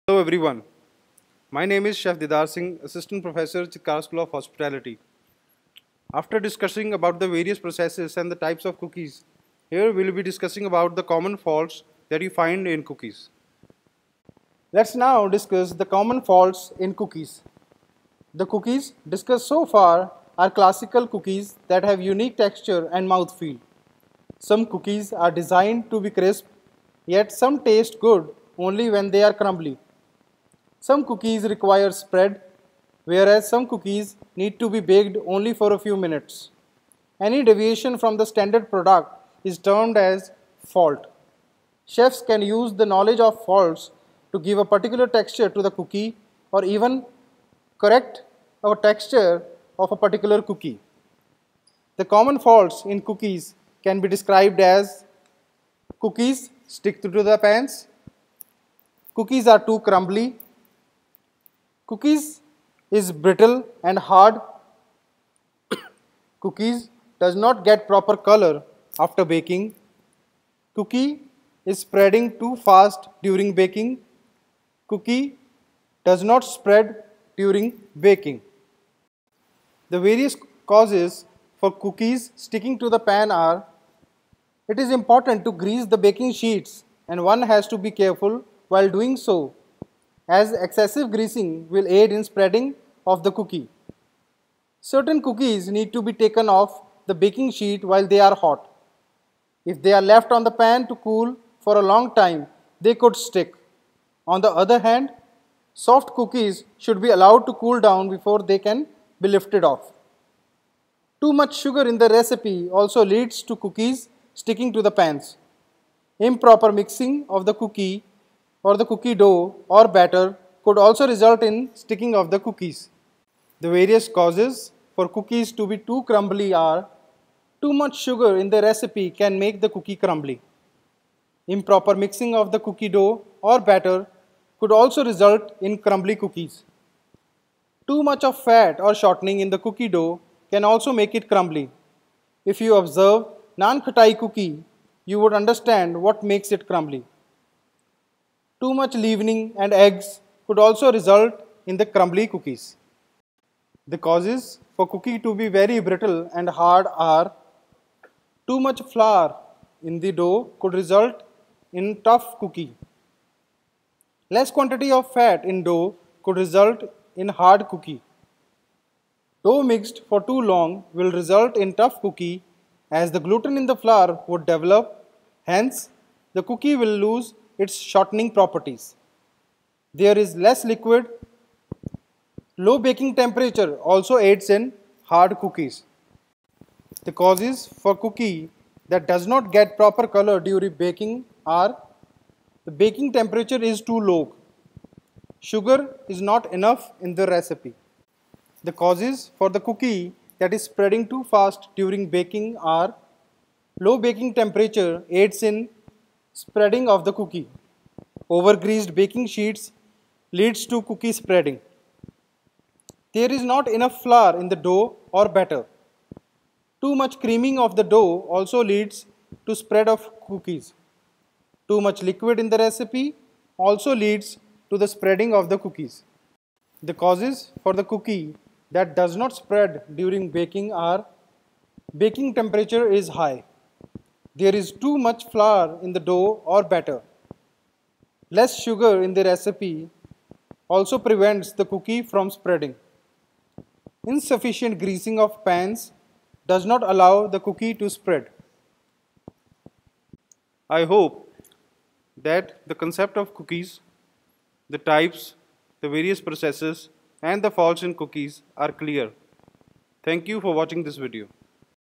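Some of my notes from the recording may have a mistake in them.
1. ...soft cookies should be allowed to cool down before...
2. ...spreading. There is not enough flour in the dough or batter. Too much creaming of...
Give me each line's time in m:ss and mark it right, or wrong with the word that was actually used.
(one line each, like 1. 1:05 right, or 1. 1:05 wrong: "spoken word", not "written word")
1. 1:45 right
2. 3:31 right.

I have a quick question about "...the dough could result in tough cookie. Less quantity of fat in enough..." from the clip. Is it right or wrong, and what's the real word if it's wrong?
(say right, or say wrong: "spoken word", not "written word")
wrong: "dough", not "enough".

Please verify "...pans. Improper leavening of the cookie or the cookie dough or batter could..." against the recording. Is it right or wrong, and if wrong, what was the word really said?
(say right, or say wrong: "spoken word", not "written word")
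wrong: "mixing", not "leavening".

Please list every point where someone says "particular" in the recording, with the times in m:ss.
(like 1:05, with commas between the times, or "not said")
0:44, 0:49.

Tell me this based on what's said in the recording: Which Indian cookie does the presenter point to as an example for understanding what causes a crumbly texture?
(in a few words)
naan khatai.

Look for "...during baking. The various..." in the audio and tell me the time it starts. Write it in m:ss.
1:17.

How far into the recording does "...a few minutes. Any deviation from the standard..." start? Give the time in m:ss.
0:35.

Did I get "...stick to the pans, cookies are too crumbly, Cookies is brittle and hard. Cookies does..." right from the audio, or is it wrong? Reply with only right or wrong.
right.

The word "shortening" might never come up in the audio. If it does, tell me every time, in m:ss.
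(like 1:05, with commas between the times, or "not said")
2:18, 2:57.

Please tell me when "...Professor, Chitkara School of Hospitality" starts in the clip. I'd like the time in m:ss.
0:03.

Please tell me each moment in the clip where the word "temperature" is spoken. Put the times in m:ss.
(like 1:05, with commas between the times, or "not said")
3:03, 3:13, 3:24, 3:52.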